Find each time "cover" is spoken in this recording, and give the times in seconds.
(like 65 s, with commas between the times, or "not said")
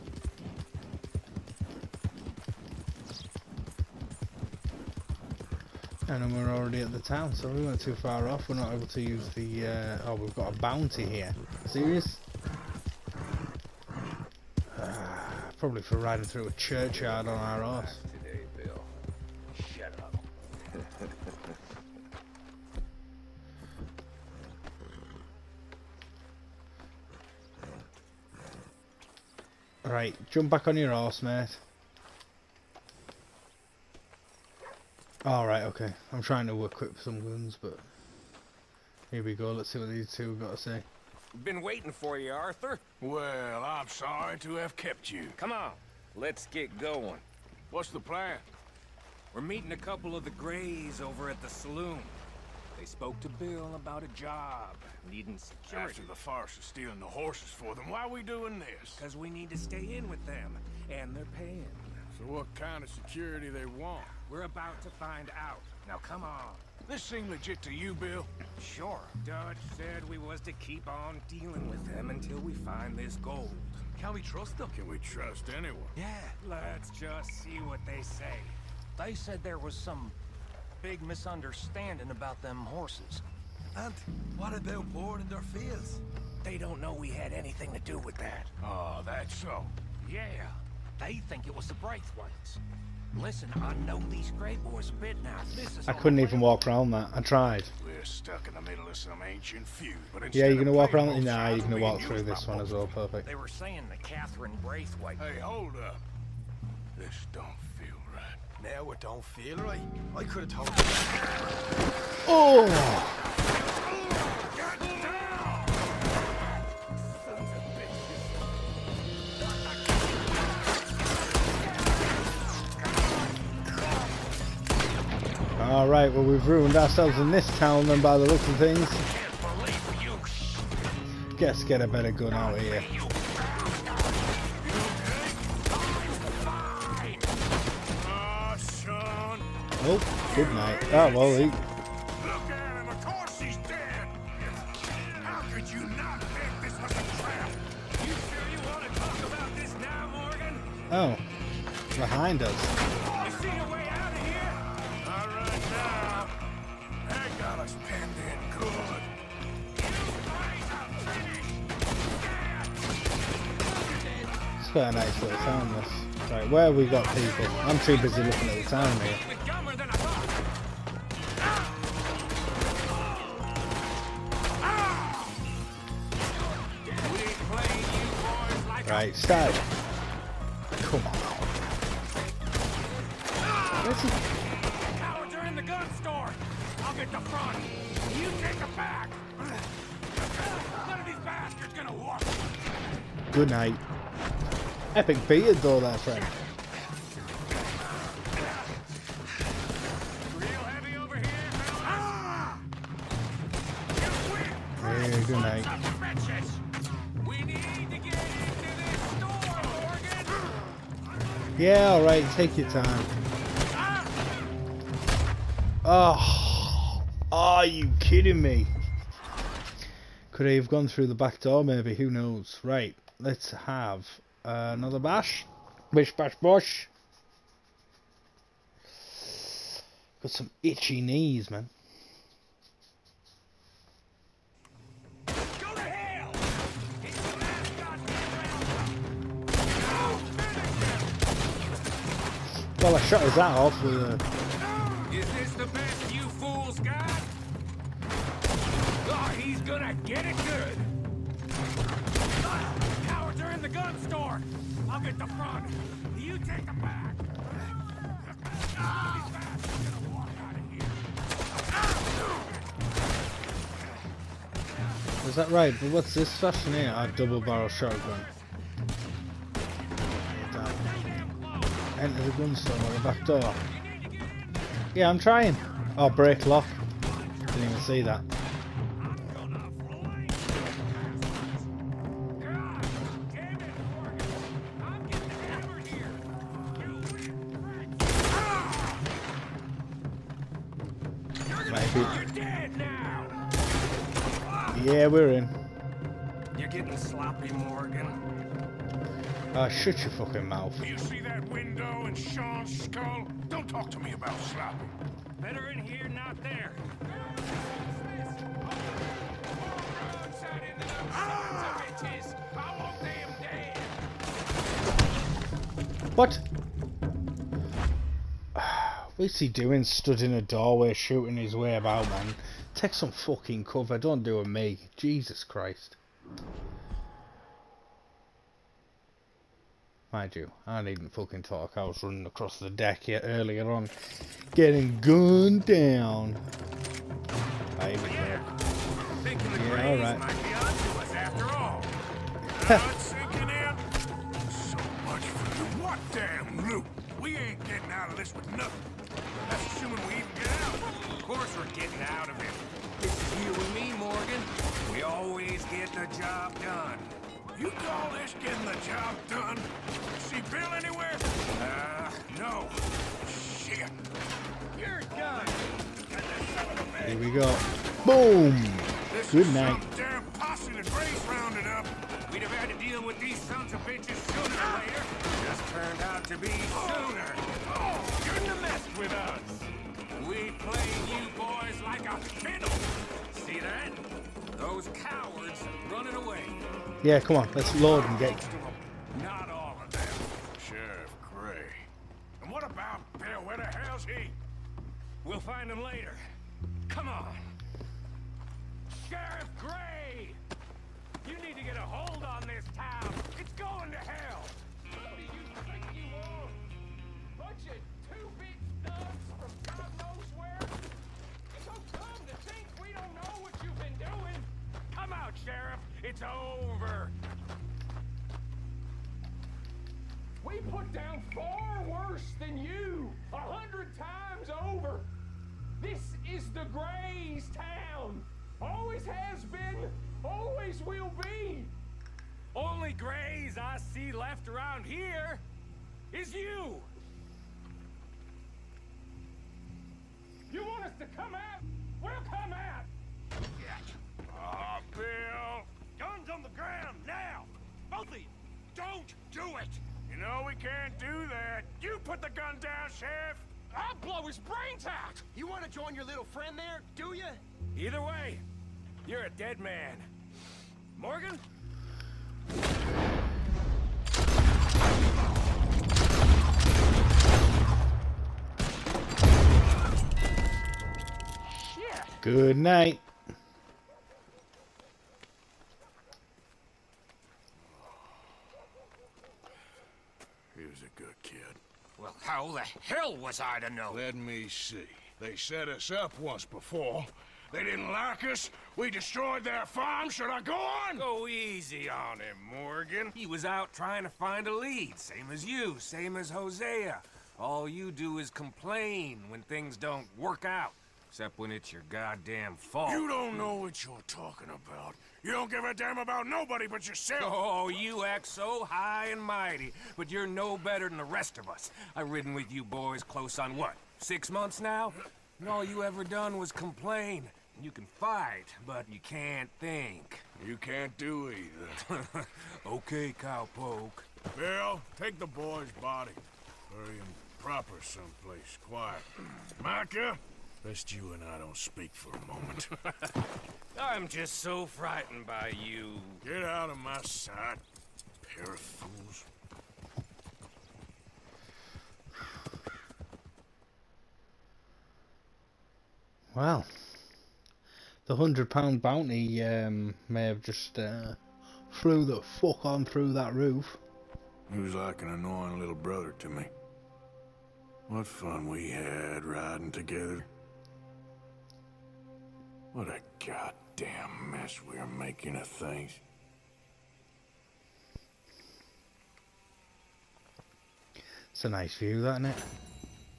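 323 s.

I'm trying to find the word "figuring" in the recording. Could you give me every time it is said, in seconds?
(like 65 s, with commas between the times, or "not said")
not said.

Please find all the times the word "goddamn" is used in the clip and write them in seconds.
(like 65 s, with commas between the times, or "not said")
501 s, 563 s.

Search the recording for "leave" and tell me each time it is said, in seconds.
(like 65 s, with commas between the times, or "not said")
not said.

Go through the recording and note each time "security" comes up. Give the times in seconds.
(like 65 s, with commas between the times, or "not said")
55 s, 62 s.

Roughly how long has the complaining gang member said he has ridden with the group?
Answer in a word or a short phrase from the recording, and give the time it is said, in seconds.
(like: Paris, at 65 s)
Six months, at 513 s.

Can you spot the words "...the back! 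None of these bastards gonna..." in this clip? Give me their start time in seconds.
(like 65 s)
188 s.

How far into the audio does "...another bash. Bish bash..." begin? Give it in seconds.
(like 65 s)
224 s.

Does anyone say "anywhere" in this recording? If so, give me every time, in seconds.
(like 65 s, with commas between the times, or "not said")
360 s.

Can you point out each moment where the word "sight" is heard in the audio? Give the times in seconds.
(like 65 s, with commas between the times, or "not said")
537 s.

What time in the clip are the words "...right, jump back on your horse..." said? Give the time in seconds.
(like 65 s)
29 s.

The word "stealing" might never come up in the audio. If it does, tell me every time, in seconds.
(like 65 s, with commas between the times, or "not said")
56 s.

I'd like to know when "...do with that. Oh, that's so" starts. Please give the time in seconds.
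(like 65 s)
87 s.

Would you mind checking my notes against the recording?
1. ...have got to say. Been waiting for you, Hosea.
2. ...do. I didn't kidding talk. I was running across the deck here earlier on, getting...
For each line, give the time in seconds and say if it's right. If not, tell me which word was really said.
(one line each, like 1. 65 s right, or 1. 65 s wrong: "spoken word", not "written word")
1. 40 s wrong: "Arthur", not "Hosea"
2. 330 s wrong: "fucking", not "kidding".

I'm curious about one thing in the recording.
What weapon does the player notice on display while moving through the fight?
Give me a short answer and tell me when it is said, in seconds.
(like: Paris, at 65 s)
Double barrel shotgun, at 267 s.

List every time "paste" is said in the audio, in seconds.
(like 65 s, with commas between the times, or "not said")
not said.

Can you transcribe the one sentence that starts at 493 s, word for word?
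He was out trying to find a lead.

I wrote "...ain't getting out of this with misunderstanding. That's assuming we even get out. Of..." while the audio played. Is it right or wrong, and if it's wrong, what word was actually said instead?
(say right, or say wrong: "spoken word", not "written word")
wrong: "nothing", not "misunderstanding".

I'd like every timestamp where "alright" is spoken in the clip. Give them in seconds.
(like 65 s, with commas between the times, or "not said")
35 s, 211 s, 339 s.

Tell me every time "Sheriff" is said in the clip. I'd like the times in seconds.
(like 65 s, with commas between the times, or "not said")
452 s.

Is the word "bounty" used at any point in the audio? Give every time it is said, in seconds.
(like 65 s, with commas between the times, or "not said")
10 s, 548 s.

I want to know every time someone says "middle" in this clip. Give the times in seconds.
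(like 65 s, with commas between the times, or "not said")
98 s.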